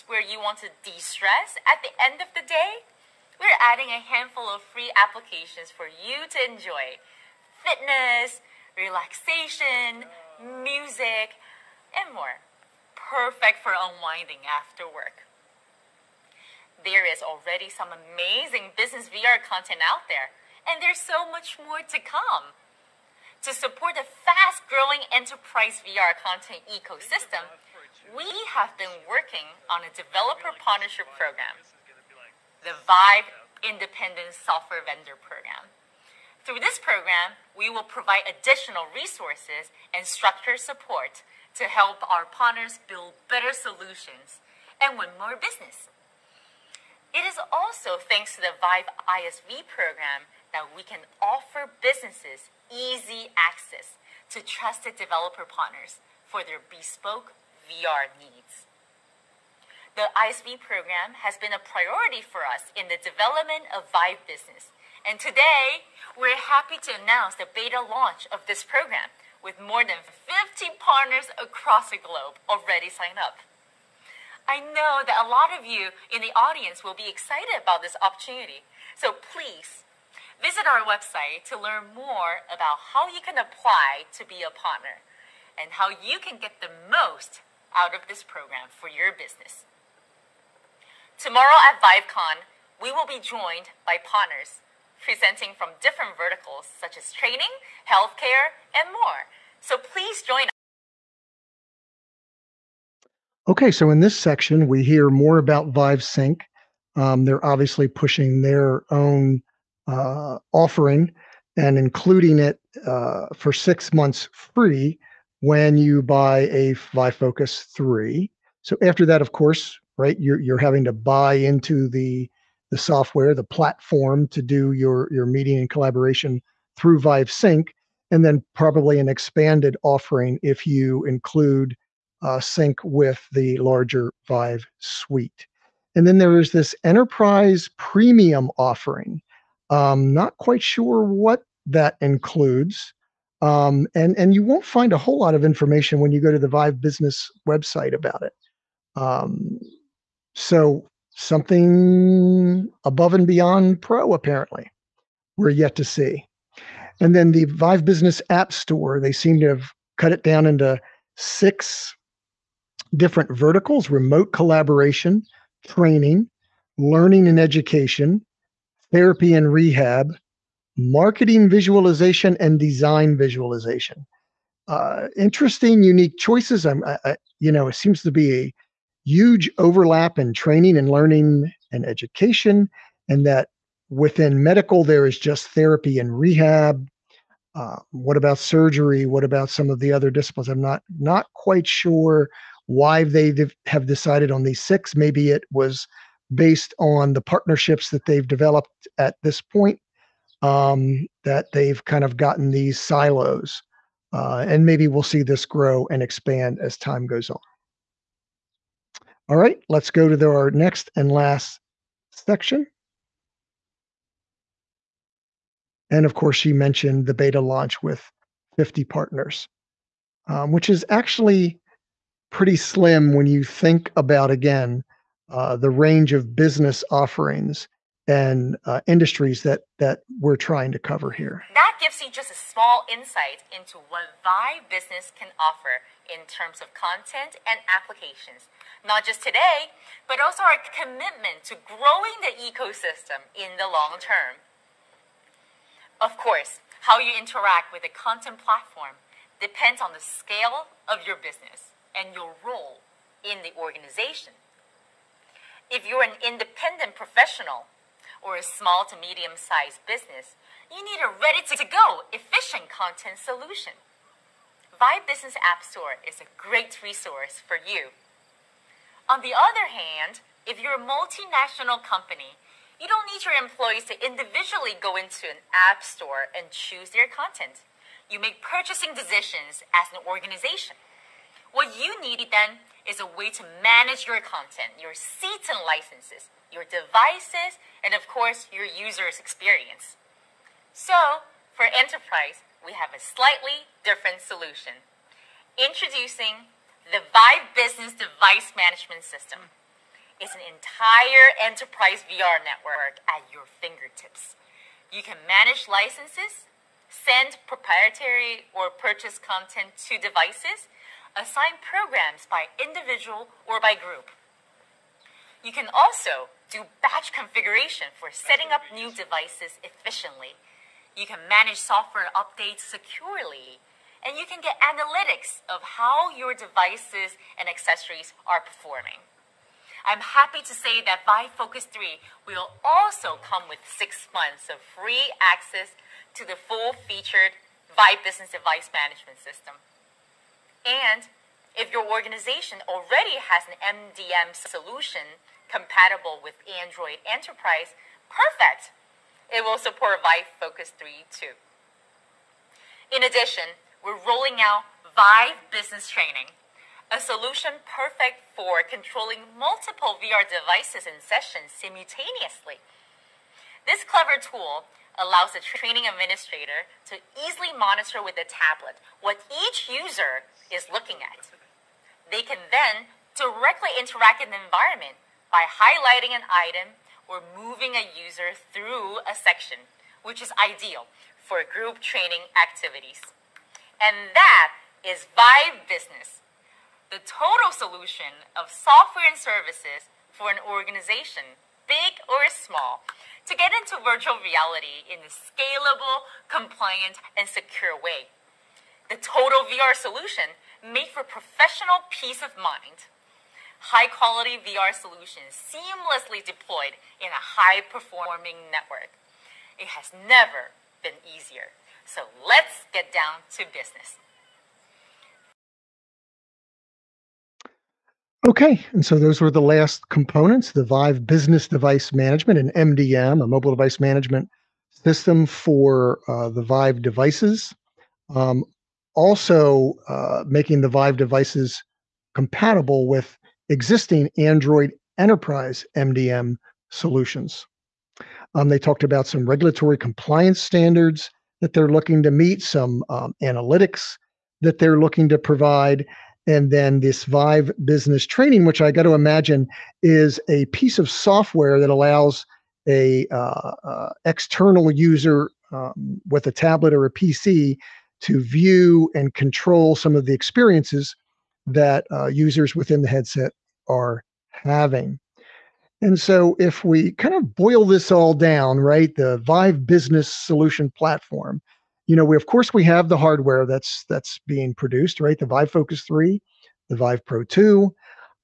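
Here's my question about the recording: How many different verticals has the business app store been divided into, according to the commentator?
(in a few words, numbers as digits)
6.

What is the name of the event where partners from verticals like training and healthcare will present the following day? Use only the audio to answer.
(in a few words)
ViveCon.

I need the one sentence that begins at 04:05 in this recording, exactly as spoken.
Of course, how you interact with the content platform depends on the scale of your business and your role in the organization.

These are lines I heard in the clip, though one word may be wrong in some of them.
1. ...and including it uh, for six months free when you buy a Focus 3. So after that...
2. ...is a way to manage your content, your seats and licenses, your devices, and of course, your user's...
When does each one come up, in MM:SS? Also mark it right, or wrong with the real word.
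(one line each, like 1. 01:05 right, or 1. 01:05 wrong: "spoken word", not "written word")
1. 01:51 right
2. 04:42 right.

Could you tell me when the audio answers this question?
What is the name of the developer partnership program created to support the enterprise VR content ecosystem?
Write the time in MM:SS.
00:32.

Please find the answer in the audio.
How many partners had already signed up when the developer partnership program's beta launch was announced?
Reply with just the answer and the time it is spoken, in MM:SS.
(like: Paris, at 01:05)
more than 50, at 01:09.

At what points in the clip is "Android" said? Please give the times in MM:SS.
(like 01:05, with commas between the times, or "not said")
05:46, 07:14.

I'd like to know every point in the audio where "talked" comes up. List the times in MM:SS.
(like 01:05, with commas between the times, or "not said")
07:18.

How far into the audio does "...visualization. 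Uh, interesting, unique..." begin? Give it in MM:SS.
02:53.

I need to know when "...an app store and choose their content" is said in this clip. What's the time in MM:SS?
04:35.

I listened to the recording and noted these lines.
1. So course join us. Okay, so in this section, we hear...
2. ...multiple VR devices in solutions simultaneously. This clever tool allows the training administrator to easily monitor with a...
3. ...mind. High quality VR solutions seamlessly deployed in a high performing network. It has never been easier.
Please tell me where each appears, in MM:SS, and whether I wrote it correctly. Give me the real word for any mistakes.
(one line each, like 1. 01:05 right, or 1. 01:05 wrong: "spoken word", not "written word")
1. 01:39 wrong: "please", not "course"
2. 05:59 wrong: "sessions", not "solutions"
3. 06:42 right.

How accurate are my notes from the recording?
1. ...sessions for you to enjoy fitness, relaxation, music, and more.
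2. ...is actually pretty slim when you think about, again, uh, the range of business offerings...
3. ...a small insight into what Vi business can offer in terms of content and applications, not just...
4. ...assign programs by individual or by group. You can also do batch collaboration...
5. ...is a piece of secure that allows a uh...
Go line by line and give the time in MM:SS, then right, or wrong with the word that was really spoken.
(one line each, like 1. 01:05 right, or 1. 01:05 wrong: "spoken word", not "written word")
1. 00:04 wrong: "applications", not "sessions"
2. 03:40 right
3. 03:52 right
4. 05:11 wrong: "configuration", not "collaboration"
5. 07:29 wrong: "software", not "secure".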